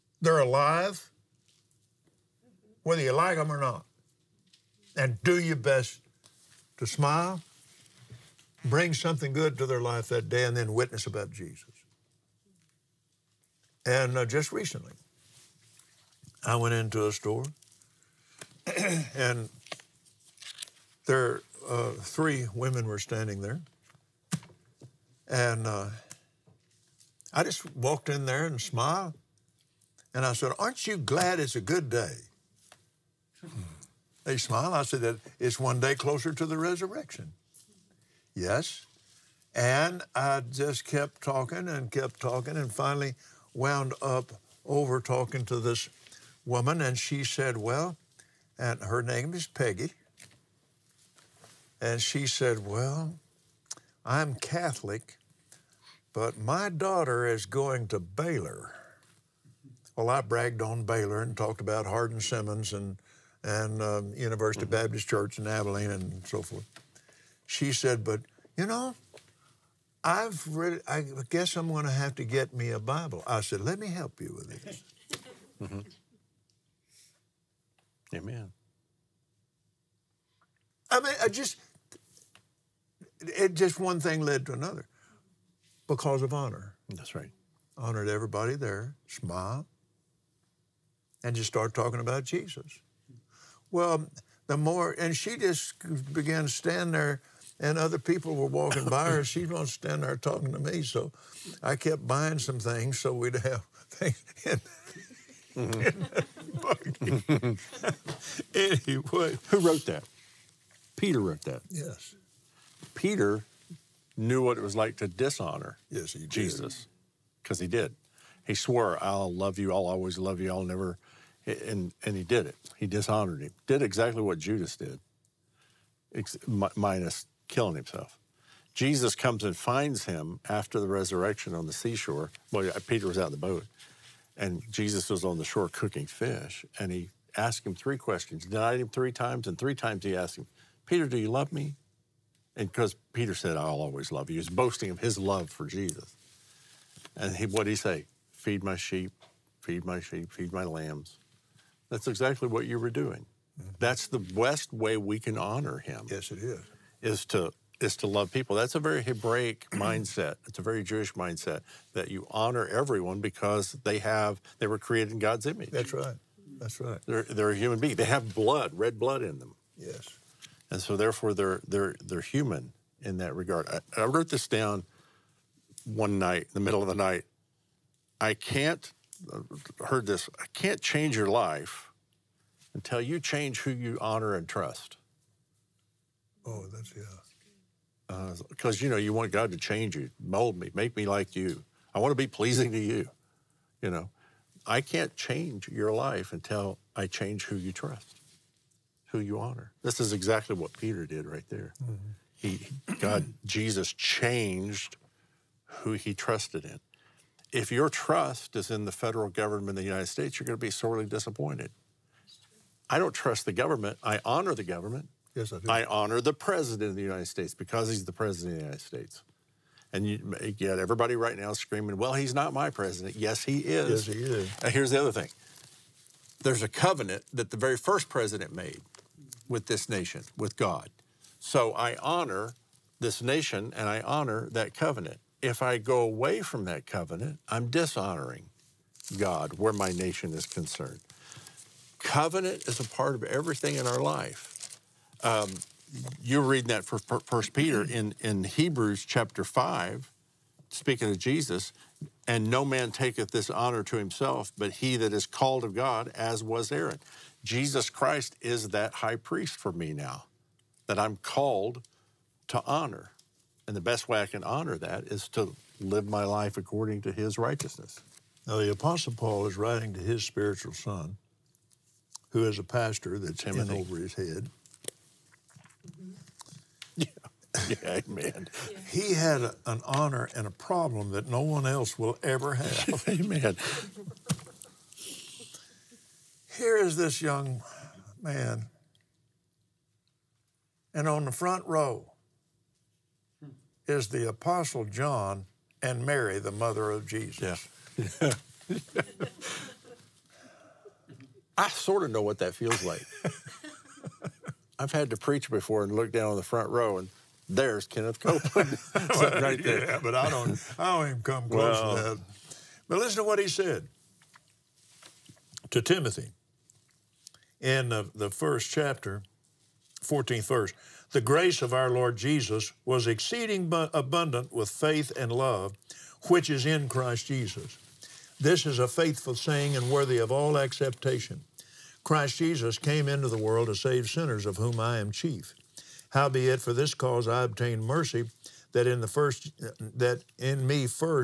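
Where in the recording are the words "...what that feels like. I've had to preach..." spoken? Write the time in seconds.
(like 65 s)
302 s.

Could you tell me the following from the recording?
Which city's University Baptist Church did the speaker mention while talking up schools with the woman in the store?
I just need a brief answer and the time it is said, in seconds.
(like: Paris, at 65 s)
Abilene, at 65 s.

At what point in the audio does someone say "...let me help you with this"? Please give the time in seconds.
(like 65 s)
73 s.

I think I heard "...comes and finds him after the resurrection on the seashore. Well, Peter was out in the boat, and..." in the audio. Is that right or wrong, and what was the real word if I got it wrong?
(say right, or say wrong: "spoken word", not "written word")
right.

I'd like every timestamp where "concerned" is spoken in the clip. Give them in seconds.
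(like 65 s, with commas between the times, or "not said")
240 s.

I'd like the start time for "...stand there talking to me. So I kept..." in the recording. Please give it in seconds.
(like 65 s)
99 s.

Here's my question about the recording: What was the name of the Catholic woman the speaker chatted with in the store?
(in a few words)
Peggy.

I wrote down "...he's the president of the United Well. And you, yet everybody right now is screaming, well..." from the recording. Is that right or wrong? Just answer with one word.
wrong.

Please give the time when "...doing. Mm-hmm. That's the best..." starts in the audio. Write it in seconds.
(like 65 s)
152 s.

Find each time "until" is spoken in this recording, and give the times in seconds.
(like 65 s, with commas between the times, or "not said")
182 s, 196 s.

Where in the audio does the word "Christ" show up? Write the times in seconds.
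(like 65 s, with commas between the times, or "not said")
257 s, 326 s, 332 s.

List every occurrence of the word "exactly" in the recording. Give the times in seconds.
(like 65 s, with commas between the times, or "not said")
123 s, 152 s, 200 s.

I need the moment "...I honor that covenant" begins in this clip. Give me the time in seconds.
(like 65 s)
233 s.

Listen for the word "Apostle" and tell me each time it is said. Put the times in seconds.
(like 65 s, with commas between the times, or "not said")
268 s, 294 s.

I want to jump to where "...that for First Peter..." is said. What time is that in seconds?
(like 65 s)
246 s.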